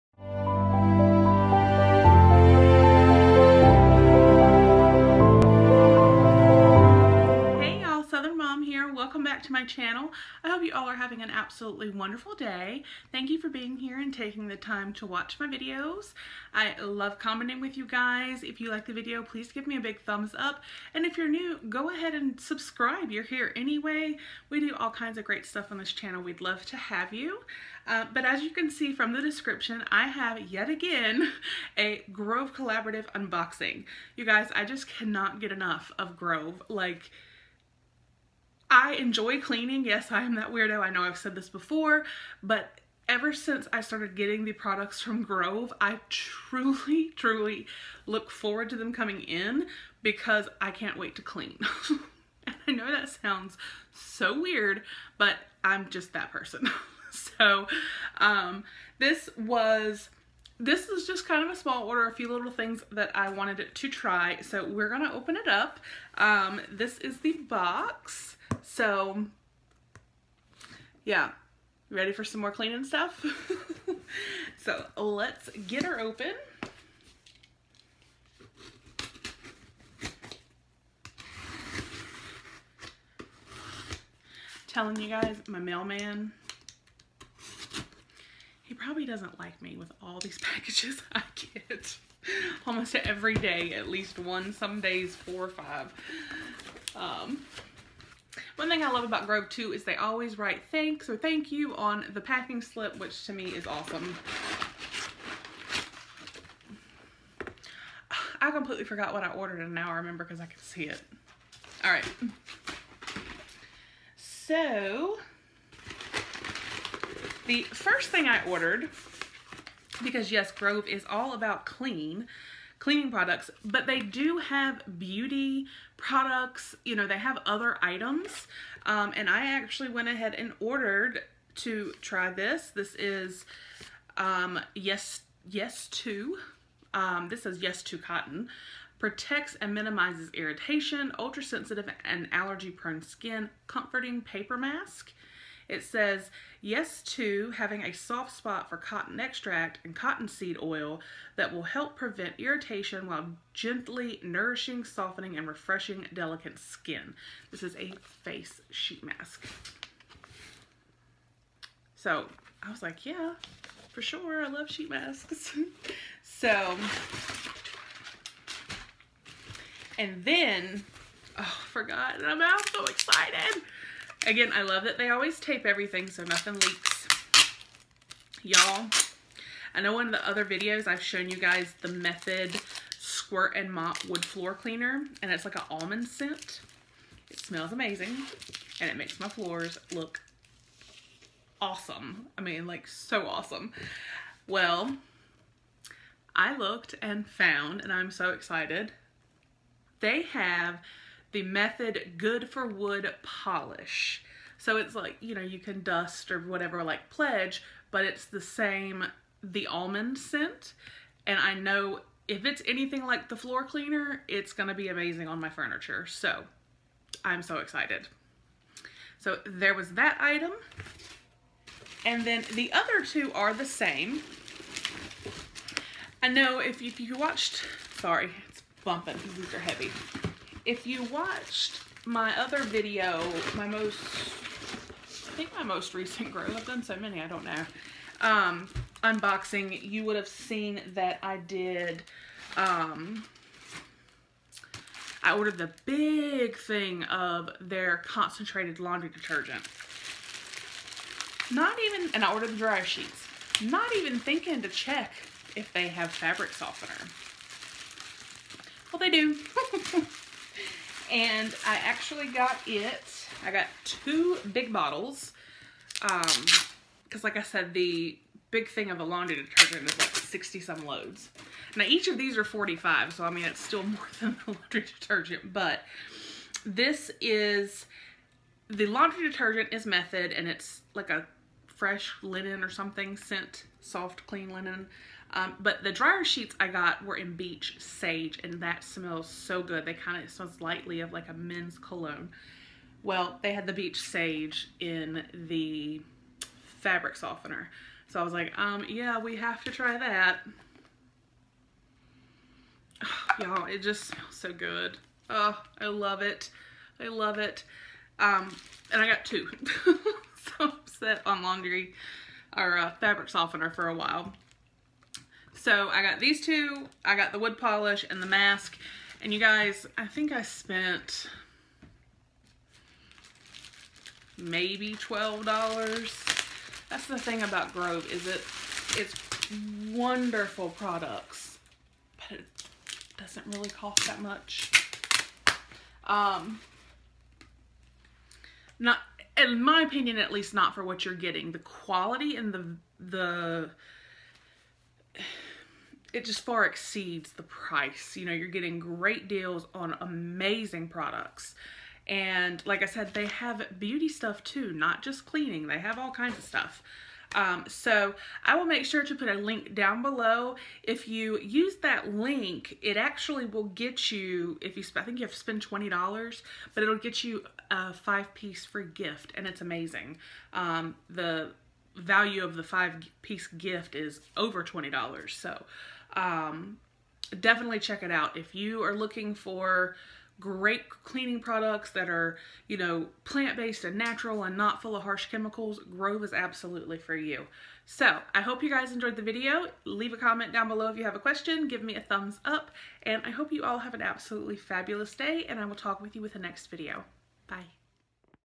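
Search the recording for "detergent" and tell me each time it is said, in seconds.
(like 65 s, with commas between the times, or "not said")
249 s, 269 s, 274 s, 279 s.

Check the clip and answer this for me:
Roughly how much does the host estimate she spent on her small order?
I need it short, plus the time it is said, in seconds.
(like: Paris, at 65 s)
$12, at 324 s.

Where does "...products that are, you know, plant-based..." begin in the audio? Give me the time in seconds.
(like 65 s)
381 s.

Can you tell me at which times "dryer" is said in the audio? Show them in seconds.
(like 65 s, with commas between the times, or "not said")
252 s, 285 s.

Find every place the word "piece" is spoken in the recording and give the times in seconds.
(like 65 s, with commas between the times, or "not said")
368 s, 373 s.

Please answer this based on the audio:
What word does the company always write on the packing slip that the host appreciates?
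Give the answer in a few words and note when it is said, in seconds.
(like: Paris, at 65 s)
thanks, at 100 s.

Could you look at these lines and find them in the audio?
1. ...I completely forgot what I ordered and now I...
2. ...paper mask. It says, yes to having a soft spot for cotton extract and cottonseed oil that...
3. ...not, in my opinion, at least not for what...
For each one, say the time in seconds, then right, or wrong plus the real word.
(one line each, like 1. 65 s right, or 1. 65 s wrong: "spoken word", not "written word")
1. 108 s right
2. 144 s right
3. 338 s right.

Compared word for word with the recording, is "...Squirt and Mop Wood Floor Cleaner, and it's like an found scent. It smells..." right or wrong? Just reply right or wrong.
wrong.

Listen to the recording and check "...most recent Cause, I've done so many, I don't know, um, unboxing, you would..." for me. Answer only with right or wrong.
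wrong.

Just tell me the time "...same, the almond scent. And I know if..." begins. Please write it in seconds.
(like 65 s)
208 s.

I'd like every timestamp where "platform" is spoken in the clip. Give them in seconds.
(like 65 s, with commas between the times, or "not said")
not said.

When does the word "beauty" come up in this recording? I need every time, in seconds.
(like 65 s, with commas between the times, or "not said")
124 s, 353 s.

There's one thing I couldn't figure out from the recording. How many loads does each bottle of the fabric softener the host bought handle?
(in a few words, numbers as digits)
45.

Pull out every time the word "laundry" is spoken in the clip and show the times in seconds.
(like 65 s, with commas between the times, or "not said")
248 s, 269 s, 274 s, 278 s, 311 s.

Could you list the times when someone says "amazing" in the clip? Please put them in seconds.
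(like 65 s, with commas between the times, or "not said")
187 s, 214 s, 350 s, 369 s.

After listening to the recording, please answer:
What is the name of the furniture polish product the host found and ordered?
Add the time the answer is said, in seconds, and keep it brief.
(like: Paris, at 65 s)
Good for Wood Polish, at 202 s.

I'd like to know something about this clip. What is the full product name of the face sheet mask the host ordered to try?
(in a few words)
Yes To Cotton.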